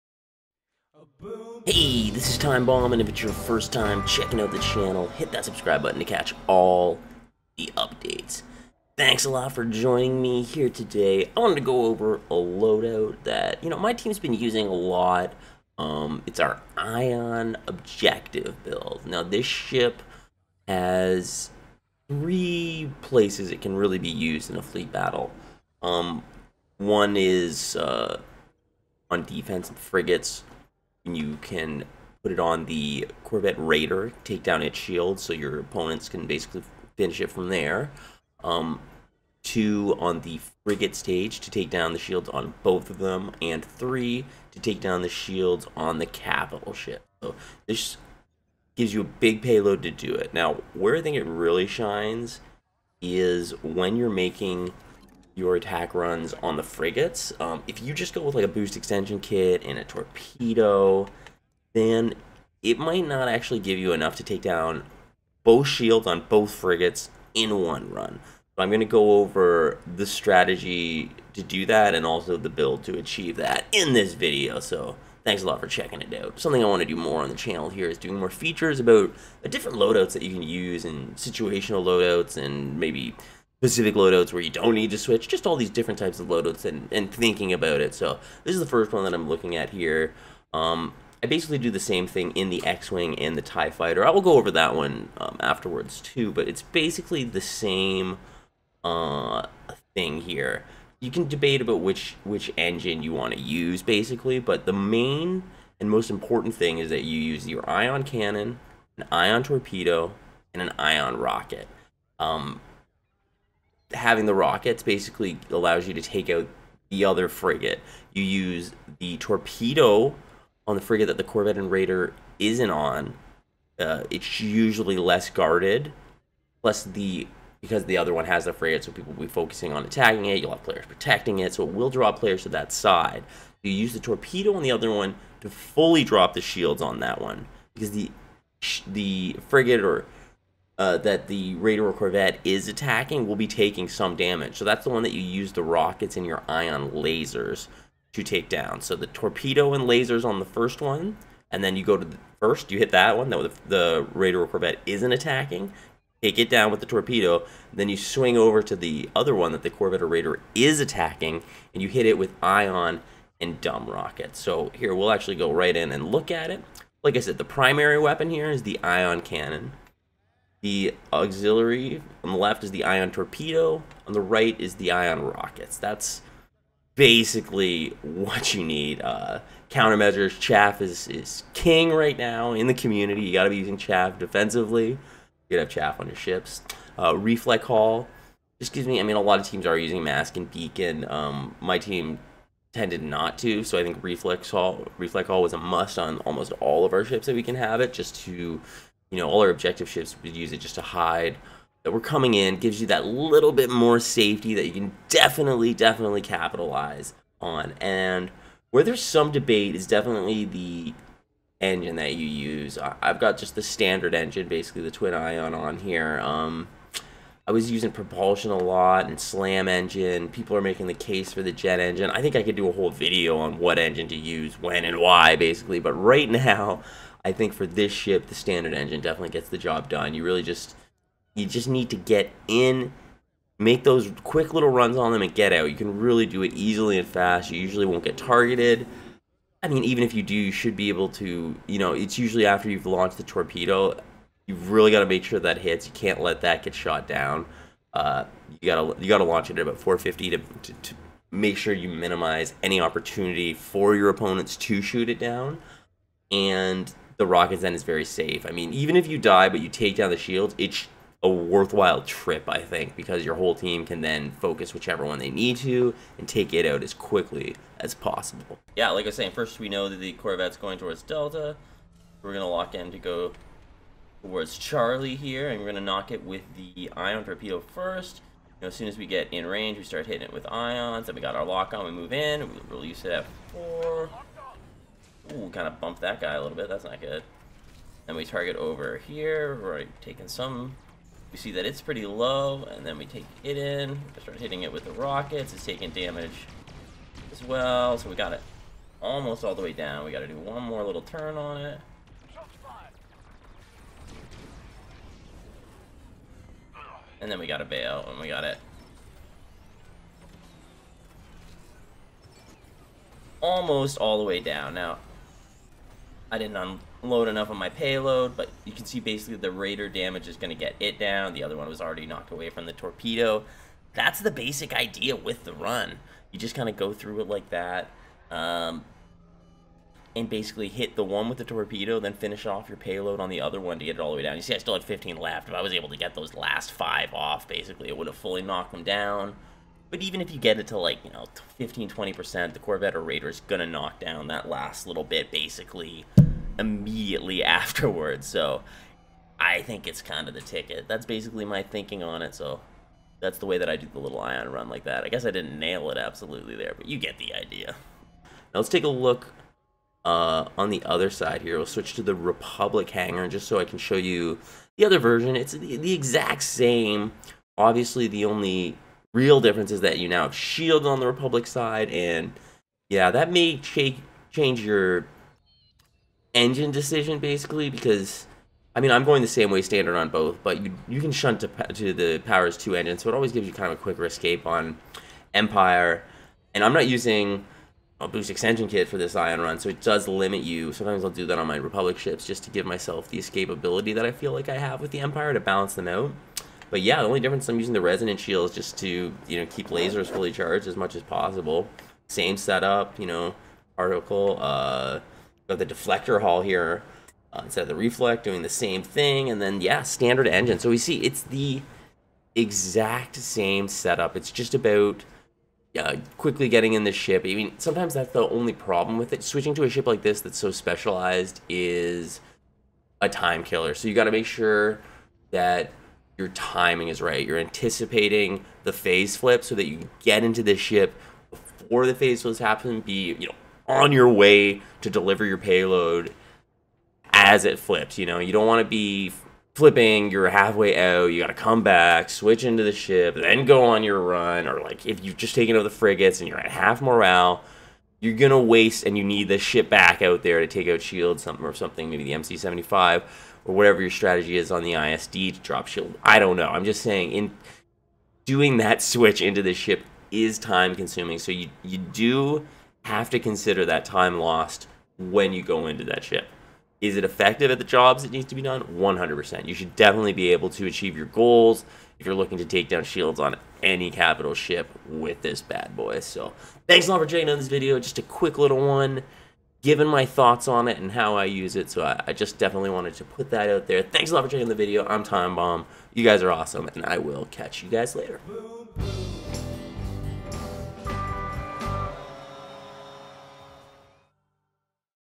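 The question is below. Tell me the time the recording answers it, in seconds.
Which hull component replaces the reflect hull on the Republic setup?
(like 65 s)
405 s.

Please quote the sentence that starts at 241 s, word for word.
You know, it's usually after you've launched the torpedo.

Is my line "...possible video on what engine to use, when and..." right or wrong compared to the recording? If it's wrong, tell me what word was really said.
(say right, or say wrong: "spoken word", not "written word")
wrong: "whole", not "possible".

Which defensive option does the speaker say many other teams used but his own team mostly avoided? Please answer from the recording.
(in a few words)
mask and beacon.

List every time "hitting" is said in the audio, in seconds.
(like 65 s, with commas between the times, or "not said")
280 s, 294 s.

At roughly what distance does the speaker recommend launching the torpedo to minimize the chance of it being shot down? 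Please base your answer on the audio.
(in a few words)
450.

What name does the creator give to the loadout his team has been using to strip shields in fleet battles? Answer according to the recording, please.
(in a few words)
Ion Objective build.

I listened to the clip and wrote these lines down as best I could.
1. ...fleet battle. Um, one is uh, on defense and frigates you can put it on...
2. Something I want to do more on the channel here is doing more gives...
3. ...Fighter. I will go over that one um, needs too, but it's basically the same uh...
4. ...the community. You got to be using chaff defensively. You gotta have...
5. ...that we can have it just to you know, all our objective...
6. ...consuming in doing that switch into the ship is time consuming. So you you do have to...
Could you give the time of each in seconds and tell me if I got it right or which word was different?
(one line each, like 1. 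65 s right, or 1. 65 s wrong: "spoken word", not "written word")
1. 24 s right
2. 76 s wrong: "features", not "gives"
3. 93 s wrong: "afterwards", not "needs"
4. 182 s right
5. 197 s right
6. 456 s wrong: "saying", not "consuming".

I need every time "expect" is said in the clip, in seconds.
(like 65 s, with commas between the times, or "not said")
not said.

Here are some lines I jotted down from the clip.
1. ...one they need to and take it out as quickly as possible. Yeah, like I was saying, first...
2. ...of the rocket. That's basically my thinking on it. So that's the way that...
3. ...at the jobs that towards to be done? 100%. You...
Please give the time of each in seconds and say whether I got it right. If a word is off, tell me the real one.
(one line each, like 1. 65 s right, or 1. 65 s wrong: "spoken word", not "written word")
1. 265 s right
2. 350 s wrong: "ticket", not "rocket"
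3. 467 s wrong: "needs", not "towards".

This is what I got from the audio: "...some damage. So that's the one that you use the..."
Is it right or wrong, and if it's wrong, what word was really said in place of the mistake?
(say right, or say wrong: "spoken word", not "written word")
right.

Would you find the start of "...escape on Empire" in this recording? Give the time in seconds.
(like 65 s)
384 s.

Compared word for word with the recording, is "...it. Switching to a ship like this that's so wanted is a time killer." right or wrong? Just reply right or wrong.
wrong.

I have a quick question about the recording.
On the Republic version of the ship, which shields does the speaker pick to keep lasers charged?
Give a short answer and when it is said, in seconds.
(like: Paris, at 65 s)
resonant shields, at 397 s.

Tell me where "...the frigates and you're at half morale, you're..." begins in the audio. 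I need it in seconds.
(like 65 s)
445 s.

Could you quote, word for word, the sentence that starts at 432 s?
Be you know on your way to deliver your payload as it flips.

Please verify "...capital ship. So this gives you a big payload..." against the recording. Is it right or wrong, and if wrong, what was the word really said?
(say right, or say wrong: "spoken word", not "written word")
right.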